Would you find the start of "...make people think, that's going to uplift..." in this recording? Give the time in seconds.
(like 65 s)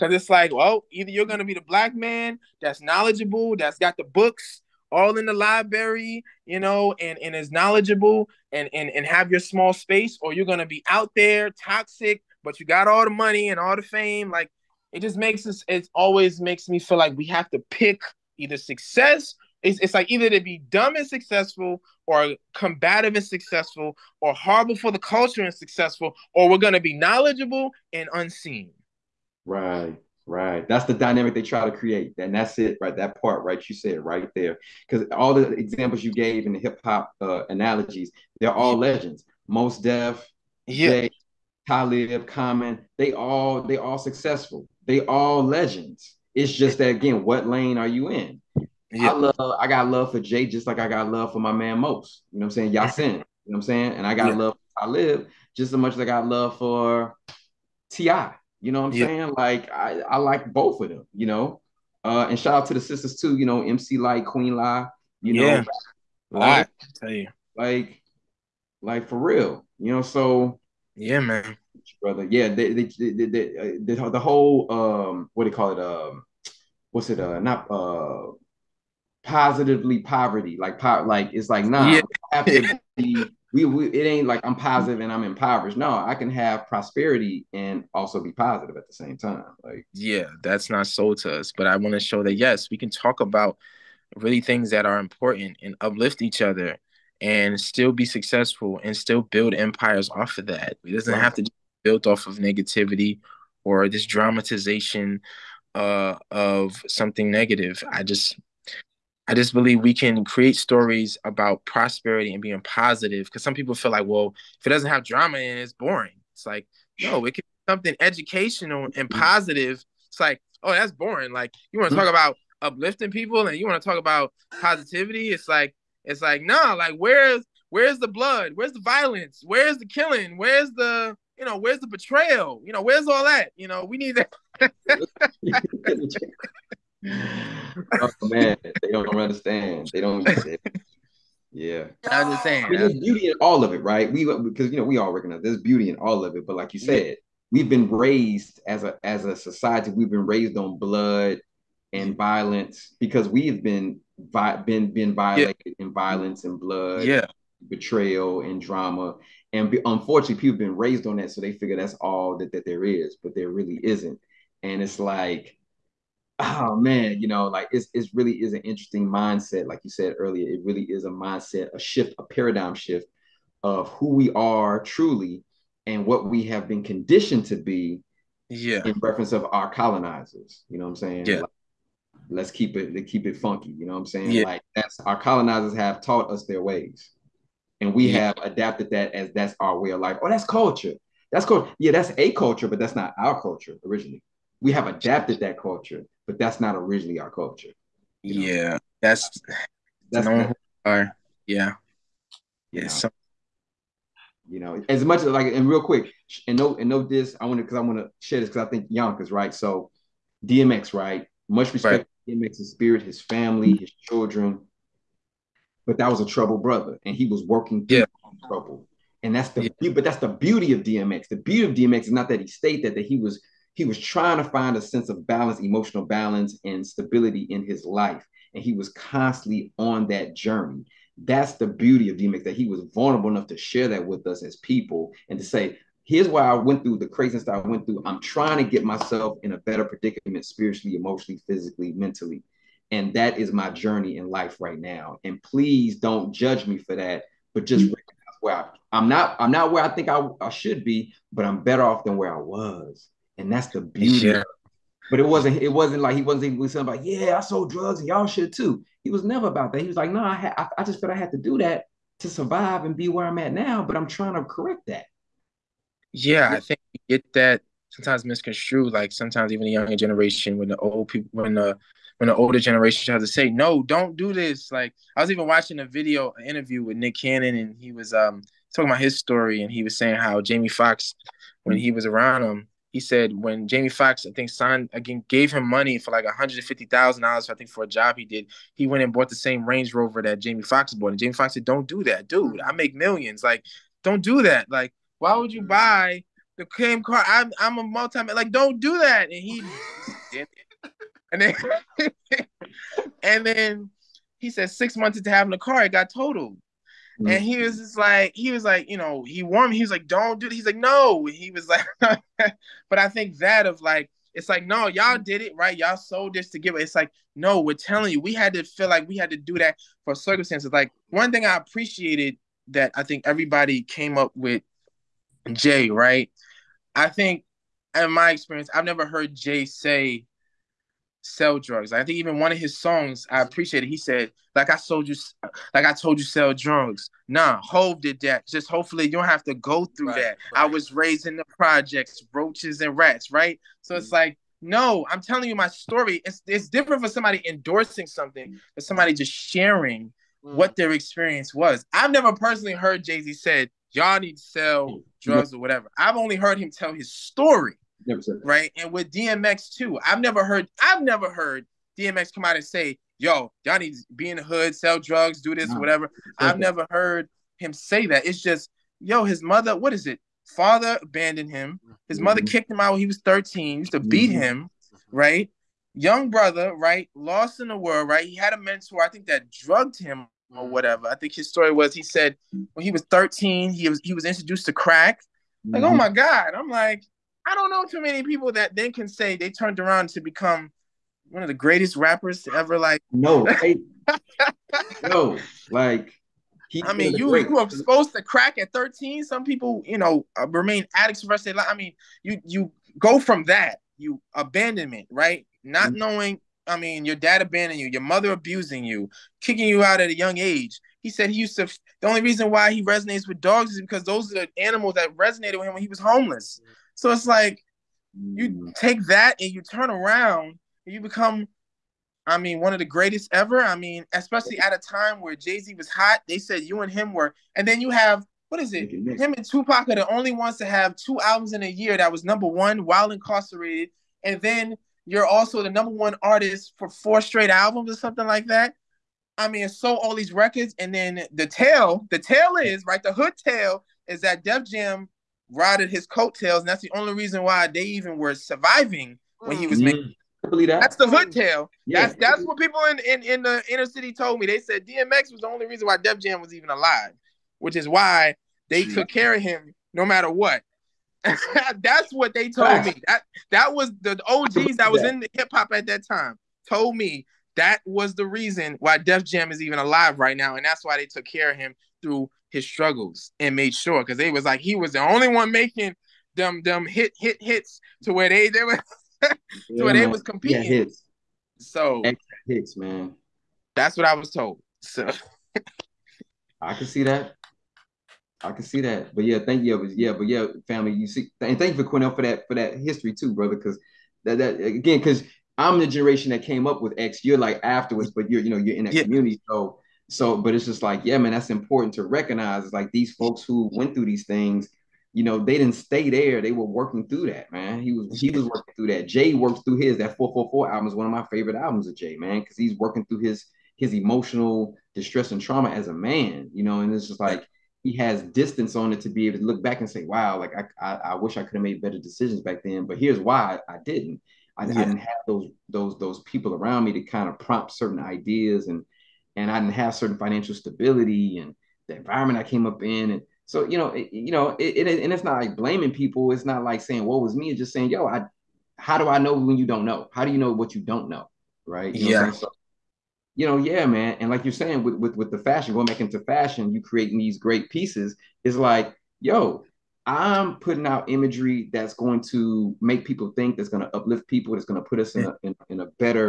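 552 s.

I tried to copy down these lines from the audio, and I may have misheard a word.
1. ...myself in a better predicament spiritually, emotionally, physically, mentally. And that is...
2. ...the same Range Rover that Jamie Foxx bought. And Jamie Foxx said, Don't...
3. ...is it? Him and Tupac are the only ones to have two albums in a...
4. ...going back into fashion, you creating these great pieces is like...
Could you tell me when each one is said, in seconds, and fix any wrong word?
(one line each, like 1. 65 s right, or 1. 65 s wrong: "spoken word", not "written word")
1. 238 s right
2. 289 s right
3. 428 s right
4. 545 s right.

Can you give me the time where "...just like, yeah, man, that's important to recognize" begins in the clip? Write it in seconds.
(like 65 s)
500 s.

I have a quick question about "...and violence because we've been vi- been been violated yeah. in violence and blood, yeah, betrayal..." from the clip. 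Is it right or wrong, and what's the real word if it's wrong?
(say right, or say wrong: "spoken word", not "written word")
right.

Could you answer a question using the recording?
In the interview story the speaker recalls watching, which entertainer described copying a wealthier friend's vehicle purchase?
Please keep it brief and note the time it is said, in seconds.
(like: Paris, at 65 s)
Nick Cannon, at 276 s.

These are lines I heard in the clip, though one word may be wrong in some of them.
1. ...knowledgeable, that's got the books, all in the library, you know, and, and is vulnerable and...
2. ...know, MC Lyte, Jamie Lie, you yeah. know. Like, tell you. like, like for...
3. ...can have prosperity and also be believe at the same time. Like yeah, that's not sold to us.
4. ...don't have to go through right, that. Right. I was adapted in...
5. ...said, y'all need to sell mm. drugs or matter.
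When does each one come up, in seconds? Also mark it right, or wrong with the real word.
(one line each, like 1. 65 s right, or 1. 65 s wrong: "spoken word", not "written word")
1. 2 s wrong: "knowledgeable", not "vulnerable"
2. 63 s wrong: "Queen", not "Jamie"
3. 86 s wrong: "positive", not "believe"
4. 339 s wrong: "raised", not "adapted"
5. 353 s wrong: "whatever", not "matter".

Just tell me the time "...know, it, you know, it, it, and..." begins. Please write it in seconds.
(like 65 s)
533 s.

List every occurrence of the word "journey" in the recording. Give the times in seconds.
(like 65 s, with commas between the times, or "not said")
230 s, 243 s.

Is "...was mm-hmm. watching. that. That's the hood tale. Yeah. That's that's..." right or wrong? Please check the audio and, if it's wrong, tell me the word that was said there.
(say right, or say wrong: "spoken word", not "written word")
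wrong: "making", not "watching".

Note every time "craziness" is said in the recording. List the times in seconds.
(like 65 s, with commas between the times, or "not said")
237 s.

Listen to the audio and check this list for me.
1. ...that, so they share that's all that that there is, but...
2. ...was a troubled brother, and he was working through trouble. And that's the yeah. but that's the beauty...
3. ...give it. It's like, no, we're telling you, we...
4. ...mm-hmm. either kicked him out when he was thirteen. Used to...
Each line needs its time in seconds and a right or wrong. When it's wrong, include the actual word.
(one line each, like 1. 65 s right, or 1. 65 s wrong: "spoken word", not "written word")
1. 161 s wrong: "figure", not "share"
2. 216 s right
3. 316 s right
4. 372 s wrong: "mother", not "either".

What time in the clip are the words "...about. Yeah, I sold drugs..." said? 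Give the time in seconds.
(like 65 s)
256 s.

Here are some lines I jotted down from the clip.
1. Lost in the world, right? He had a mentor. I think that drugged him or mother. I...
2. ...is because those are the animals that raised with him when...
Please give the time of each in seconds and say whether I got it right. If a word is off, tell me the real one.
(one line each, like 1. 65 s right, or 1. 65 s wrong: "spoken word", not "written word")
1. 377 s wrong: "whatever", not "mother"
2. 413 s wrong: "resonated", not "raised".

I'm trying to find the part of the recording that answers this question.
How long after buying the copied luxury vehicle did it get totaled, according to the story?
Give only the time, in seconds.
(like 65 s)
304 s.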